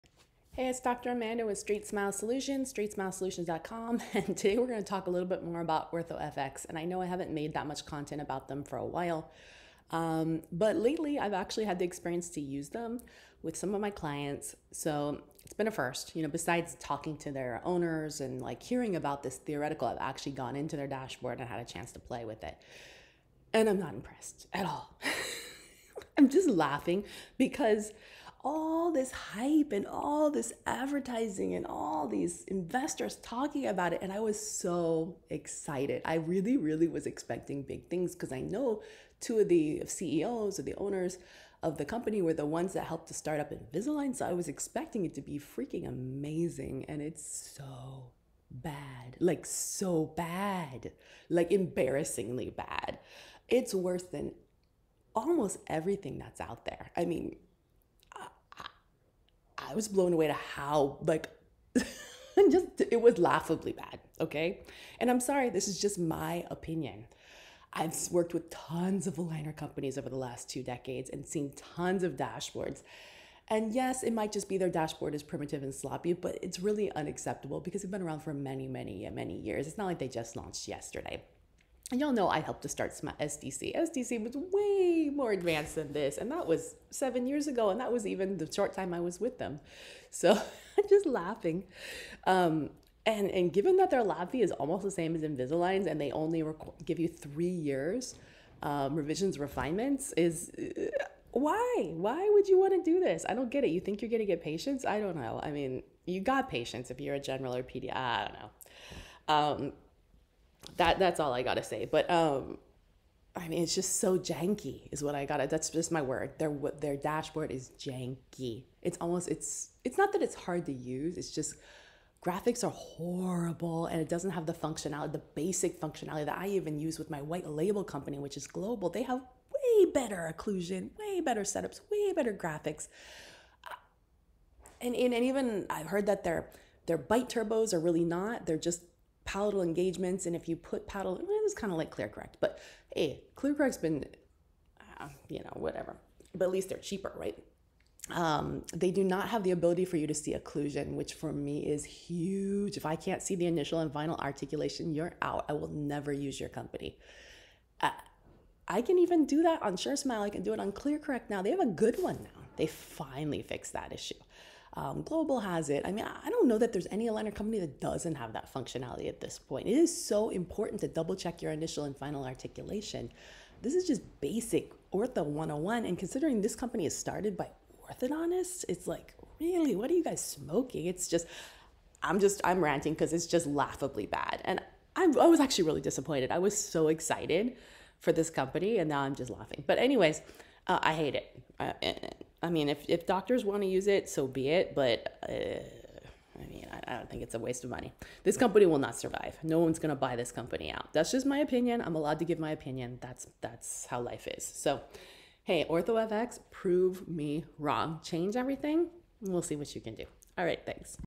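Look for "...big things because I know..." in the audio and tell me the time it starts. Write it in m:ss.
0:37.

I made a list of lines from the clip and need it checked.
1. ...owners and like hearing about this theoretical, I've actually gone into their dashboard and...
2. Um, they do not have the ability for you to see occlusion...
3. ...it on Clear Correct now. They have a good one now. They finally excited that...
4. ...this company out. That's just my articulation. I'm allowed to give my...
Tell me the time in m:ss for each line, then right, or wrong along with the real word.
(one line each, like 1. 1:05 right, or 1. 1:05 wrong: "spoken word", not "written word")
1. 0:17 right
2. 2:28 right
3. 2:40 wrong: "fixed", not "excited"
4. 3:20 wrong: "opinion", not "articulation".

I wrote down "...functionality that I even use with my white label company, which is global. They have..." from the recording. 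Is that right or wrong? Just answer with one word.
right.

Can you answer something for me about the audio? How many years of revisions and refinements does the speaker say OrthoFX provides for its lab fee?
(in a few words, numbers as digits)
3 years.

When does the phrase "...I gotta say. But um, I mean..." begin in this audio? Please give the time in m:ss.
1:51.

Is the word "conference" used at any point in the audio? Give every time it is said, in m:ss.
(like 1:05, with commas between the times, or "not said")
not said.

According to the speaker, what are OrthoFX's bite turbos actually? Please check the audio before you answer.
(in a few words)
Palatal engagements.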